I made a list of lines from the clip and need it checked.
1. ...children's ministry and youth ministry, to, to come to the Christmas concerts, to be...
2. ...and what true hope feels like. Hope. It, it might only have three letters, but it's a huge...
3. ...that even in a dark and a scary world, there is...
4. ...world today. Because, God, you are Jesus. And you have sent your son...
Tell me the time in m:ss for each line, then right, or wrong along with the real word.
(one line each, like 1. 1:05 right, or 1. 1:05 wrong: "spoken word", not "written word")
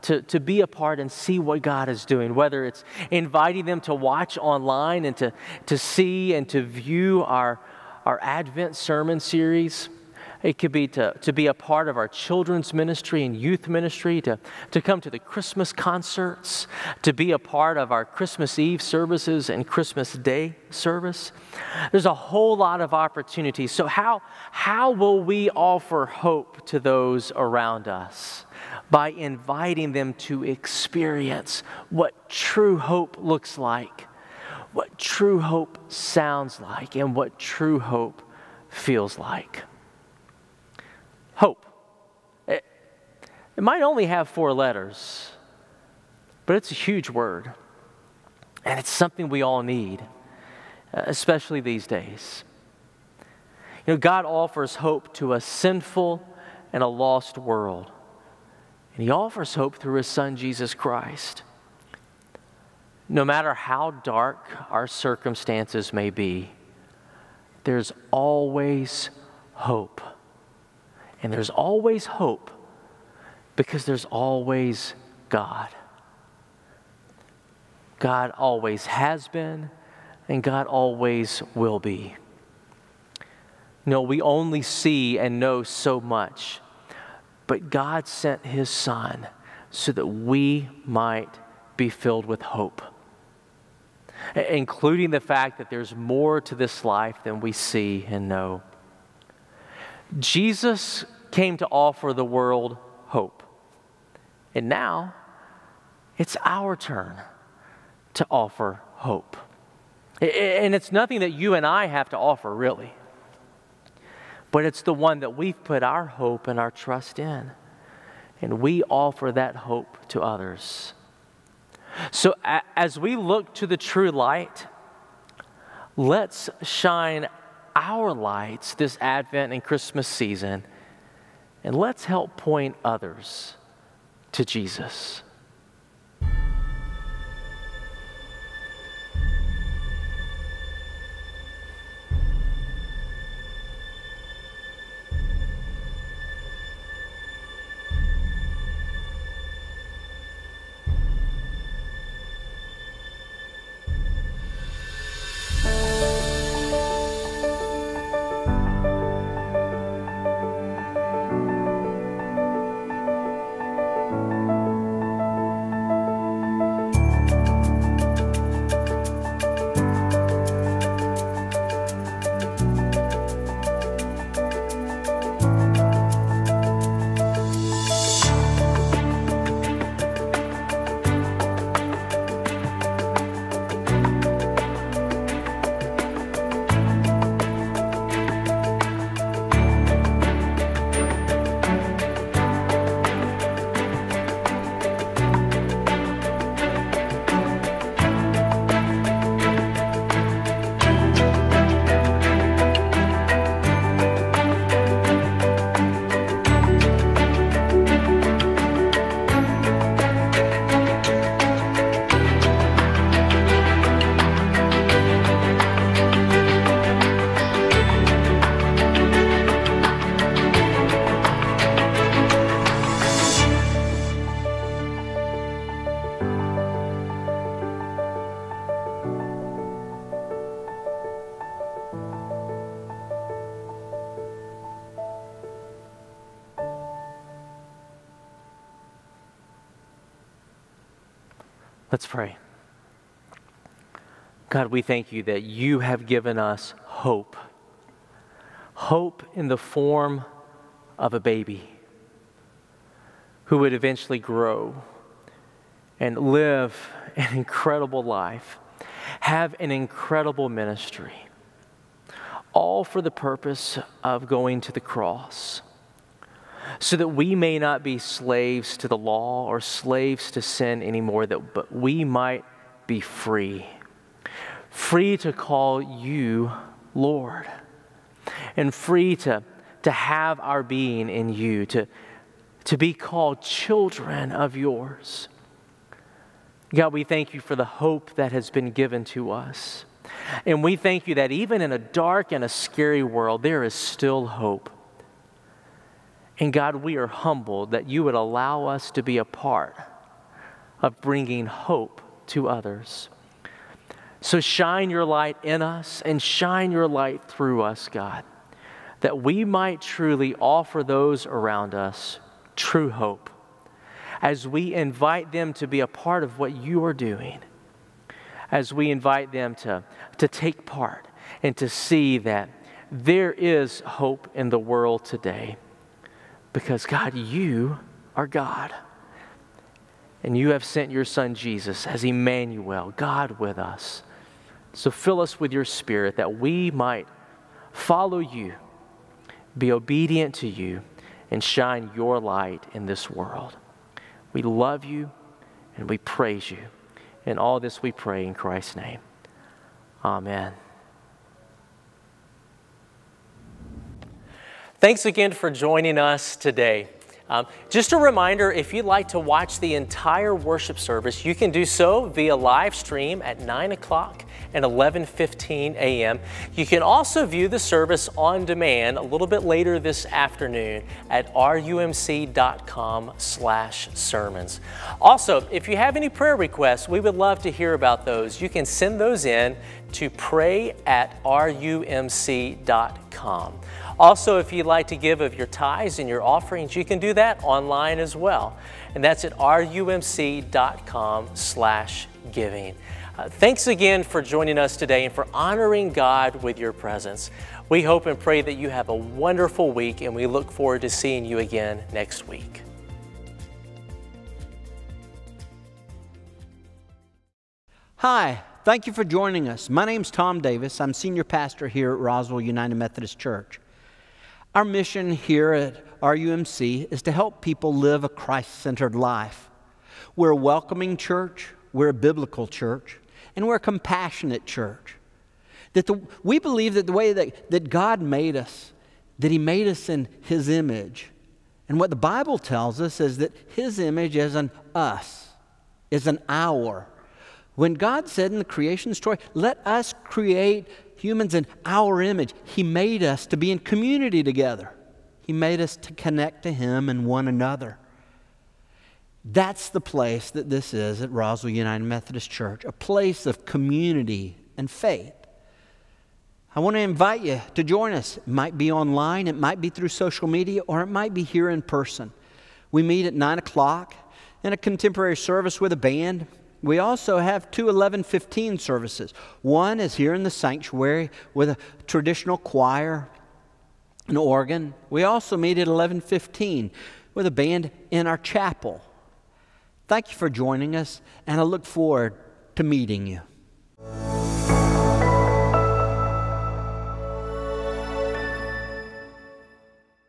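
1. 0:12 right
2. 0:36 wrong: "four", not "three"
3. 4:51 right
4. 5:24 wrong: "God", not "Jesus".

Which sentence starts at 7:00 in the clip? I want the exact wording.
We're a welcoming church, we're a biblical church, and we're a compassionate church.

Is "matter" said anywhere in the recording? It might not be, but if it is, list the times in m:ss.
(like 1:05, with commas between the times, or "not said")
1:03.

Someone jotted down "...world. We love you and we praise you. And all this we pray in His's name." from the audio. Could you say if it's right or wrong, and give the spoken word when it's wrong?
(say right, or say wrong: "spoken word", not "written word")
wrong: "Christ", not "His".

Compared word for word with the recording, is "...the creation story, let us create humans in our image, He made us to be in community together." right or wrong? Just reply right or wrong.
right.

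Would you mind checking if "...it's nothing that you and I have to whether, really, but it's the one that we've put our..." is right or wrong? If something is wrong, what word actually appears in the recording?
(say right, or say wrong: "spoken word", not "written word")
wrong: "offer", not "whether".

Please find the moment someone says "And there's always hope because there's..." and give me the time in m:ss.
1:11.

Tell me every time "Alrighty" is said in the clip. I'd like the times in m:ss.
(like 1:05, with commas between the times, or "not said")
not said.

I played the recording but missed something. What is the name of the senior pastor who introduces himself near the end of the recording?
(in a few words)
Tom Davis.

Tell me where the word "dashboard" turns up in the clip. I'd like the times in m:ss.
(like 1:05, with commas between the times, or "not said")
not said.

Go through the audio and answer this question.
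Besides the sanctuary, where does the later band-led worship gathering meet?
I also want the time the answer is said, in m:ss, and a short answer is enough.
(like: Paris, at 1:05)
chapel, at 7:58.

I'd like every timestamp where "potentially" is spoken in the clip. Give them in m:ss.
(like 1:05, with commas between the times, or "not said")
not said.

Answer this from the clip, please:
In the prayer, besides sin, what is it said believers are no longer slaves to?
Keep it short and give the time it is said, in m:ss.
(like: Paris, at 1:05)
the law, at 4:28.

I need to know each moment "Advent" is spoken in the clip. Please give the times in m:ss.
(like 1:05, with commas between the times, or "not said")
0:08, 2:09.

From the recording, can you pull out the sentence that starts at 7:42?
We meet at 9 o'clock in a contemporary service with a band.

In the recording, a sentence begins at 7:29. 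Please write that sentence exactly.
That's the place that this is at Roswell United Methodist Church, a place of community and faith.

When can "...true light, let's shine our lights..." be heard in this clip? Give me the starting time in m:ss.
2:03.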